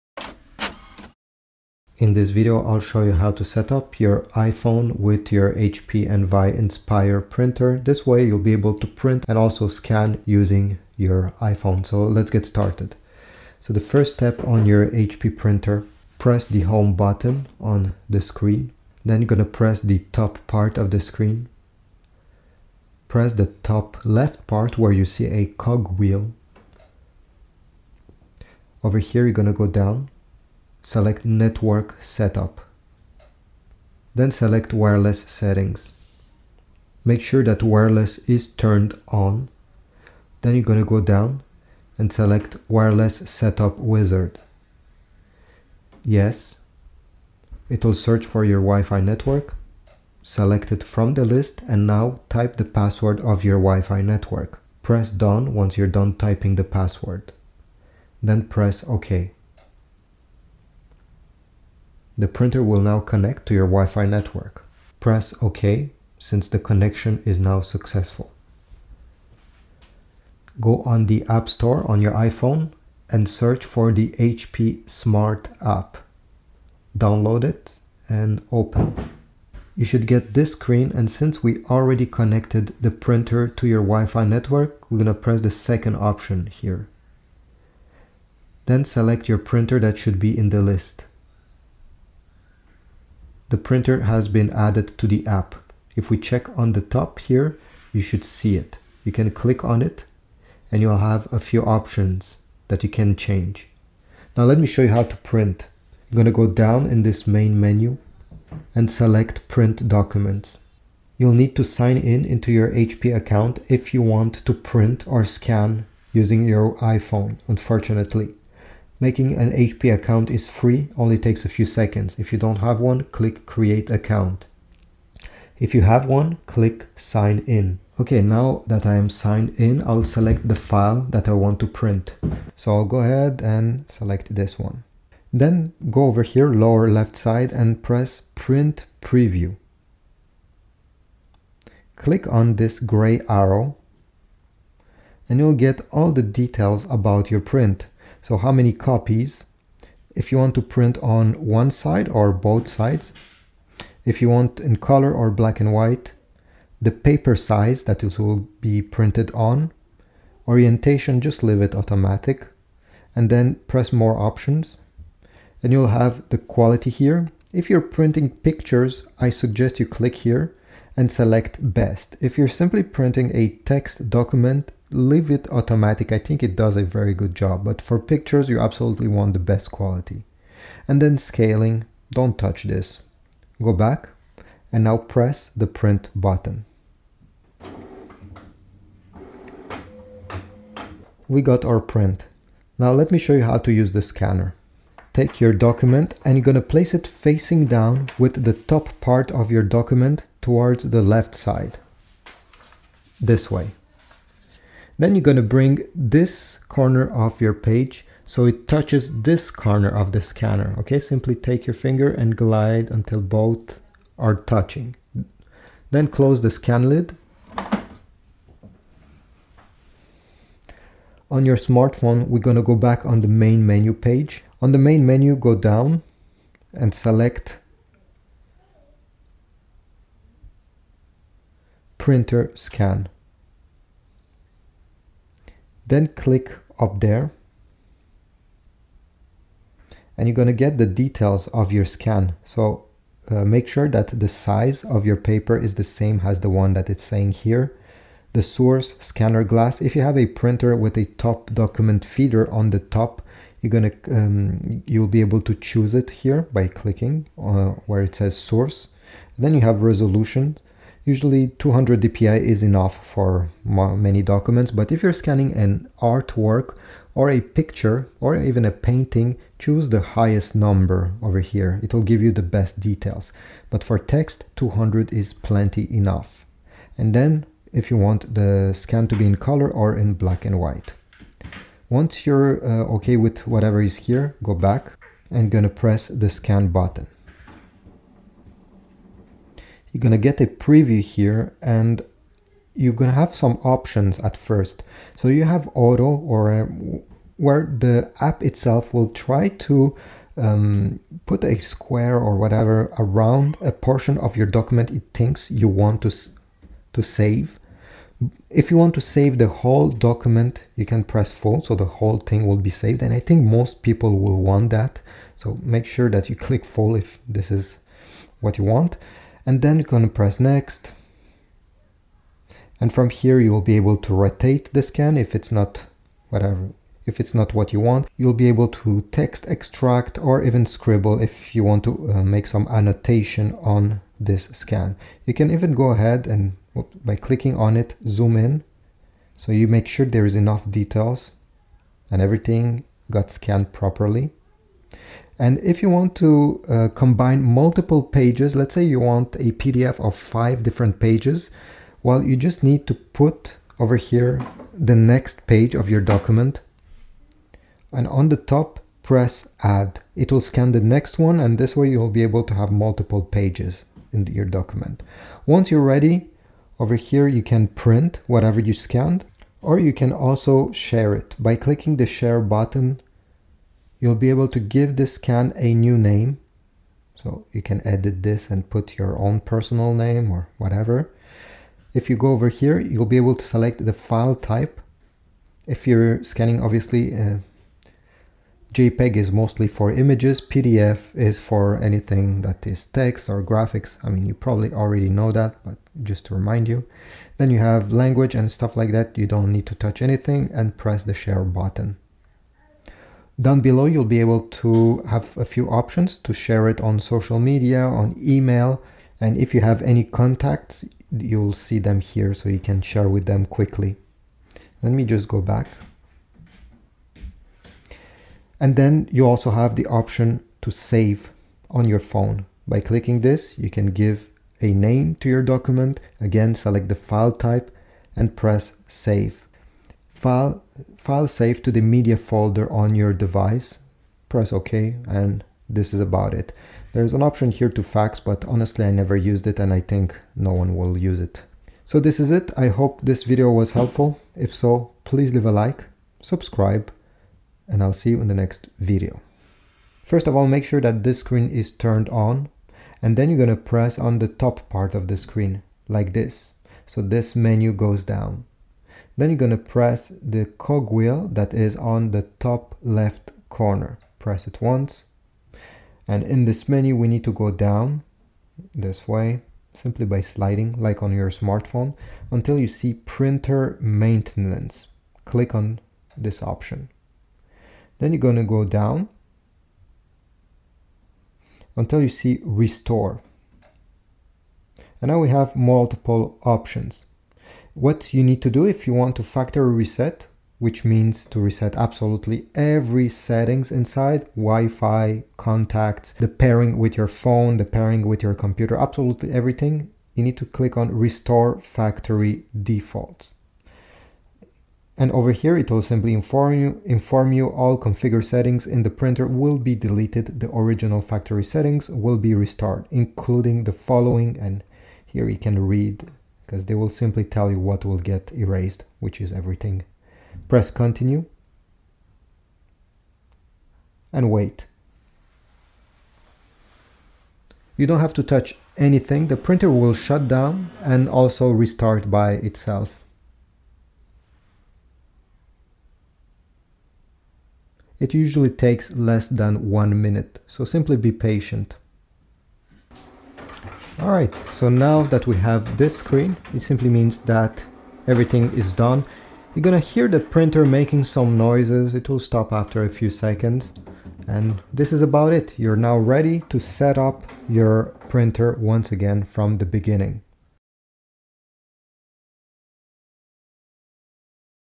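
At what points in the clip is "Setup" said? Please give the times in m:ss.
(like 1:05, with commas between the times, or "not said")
0:32, 0:43.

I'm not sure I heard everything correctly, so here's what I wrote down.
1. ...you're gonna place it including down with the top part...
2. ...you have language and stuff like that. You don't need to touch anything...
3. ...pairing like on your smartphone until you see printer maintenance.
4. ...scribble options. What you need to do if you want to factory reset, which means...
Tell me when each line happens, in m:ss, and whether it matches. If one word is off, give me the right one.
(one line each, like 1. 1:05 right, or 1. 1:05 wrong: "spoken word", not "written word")
1. 3:16 wrong: "facing", not "including"
2. 6:37 right
3. 7:50 wrong: "sliding", not "pairing"
4. 8:05 wrong: "multiple", not "scribble".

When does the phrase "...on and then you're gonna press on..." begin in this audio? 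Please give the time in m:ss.
7:32.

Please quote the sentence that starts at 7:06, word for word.
Again, select the file type and press save.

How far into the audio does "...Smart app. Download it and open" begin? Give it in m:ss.
1:14.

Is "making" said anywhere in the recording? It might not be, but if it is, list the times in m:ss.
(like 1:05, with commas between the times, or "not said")
1:59, 9:10.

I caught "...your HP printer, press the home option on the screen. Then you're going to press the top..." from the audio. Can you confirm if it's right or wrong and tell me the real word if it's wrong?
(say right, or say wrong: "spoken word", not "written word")
wrong: "button", not "option".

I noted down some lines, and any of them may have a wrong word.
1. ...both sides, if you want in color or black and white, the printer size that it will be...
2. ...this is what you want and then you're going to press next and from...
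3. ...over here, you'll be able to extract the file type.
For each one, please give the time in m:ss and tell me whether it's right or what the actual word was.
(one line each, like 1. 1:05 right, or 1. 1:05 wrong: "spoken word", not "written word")
1. 2:32 wrong: "paper", not "printer"
2. 5:17 right
3. 6:22 wrong: "select", not "extract".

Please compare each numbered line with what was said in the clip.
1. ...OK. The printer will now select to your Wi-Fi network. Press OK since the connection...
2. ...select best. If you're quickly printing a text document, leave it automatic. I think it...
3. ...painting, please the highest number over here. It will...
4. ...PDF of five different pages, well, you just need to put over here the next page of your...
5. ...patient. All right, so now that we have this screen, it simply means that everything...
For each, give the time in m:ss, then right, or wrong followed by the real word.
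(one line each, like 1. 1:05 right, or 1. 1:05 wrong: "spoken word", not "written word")
1. 0:58 wrong: "connect", not "select"
2. 2:51 wrong: "simply", not "quickly"
3. 4:28 wrong: "choose", not "please"
4. 5:49 right
5. 9:01 right.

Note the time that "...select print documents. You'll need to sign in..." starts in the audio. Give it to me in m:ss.
1:48.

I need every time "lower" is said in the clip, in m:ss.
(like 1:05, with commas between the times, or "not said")
2:16.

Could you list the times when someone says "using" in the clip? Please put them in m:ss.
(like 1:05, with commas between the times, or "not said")
0:10, 1:56.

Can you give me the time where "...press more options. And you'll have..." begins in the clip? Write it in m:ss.
2:43.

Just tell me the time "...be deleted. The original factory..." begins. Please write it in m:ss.
8:29.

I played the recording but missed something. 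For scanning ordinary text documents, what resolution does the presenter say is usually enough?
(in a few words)
200 dpi.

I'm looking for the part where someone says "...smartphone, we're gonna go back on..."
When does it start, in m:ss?
3:41.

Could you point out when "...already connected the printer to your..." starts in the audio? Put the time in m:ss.
1:21.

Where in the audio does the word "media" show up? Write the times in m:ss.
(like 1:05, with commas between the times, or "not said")
6:47, 7:11.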